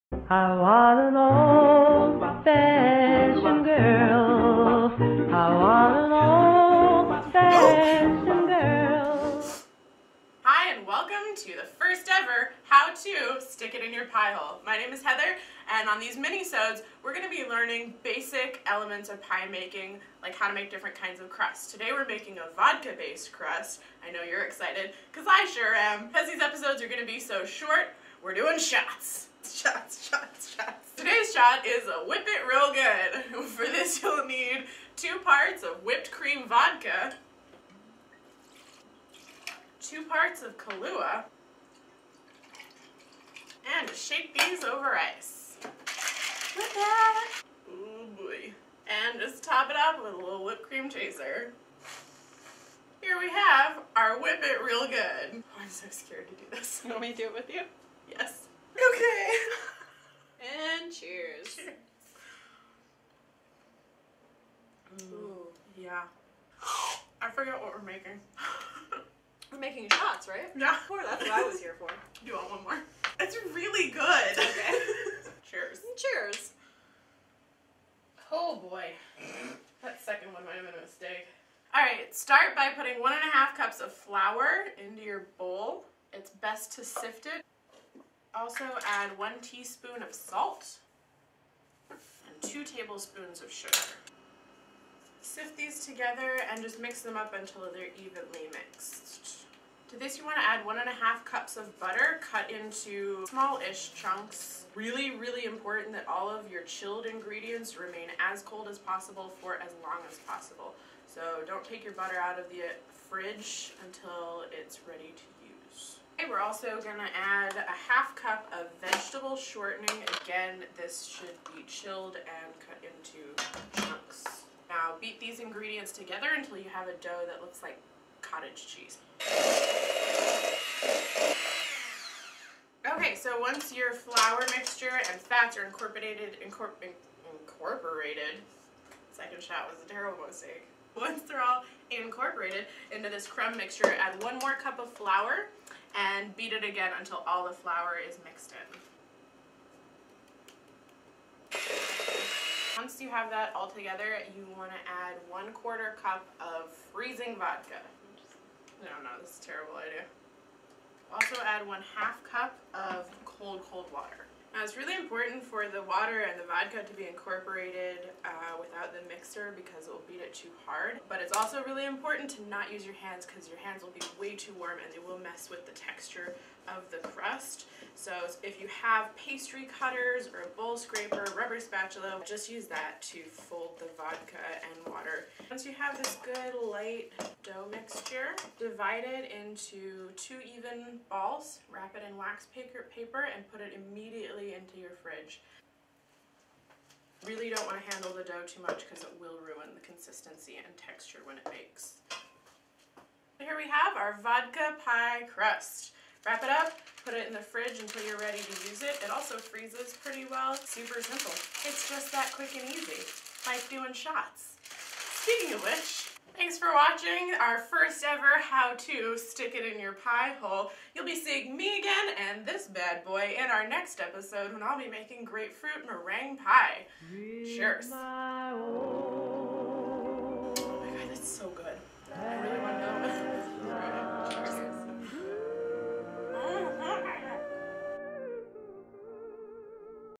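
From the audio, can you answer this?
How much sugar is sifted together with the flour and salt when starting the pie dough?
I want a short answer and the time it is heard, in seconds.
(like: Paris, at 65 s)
2 tablespoons, at 92 s.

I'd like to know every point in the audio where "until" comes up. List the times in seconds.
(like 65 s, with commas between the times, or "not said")
97 s, 113 s, 126 s, 146 s, 207 s.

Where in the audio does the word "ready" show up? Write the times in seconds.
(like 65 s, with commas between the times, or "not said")
114 s, 208 s.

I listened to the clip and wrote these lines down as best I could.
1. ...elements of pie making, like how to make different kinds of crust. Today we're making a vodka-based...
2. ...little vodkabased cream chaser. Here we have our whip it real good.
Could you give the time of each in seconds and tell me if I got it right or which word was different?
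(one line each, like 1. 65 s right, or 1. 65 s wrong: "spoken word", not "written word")
1. 18 s right
2. 50 s wrong: "whipped", not "vodkabased".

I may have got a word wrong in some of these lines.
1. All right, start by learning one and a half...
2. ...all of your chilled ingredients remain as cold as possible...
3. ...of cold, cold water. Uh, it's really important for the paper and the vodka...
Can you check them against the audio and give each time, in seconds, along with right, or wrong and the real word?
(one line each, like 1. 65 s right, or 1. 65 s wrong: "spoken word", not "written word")
1. 81 s wrong: "putting", not "learning"
2. 106 s right
3. 162 s wrong: "water", not "paper".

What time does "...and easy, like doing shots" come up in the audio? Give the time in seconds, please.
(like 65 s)
212 s.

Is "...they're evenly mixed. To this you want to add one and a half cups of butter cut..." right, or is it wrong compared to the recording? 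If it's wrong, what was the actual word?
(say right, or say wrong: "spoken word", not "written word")
right.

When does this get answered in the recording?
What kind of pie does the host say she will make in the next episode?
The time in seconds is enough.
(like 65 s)
225 s.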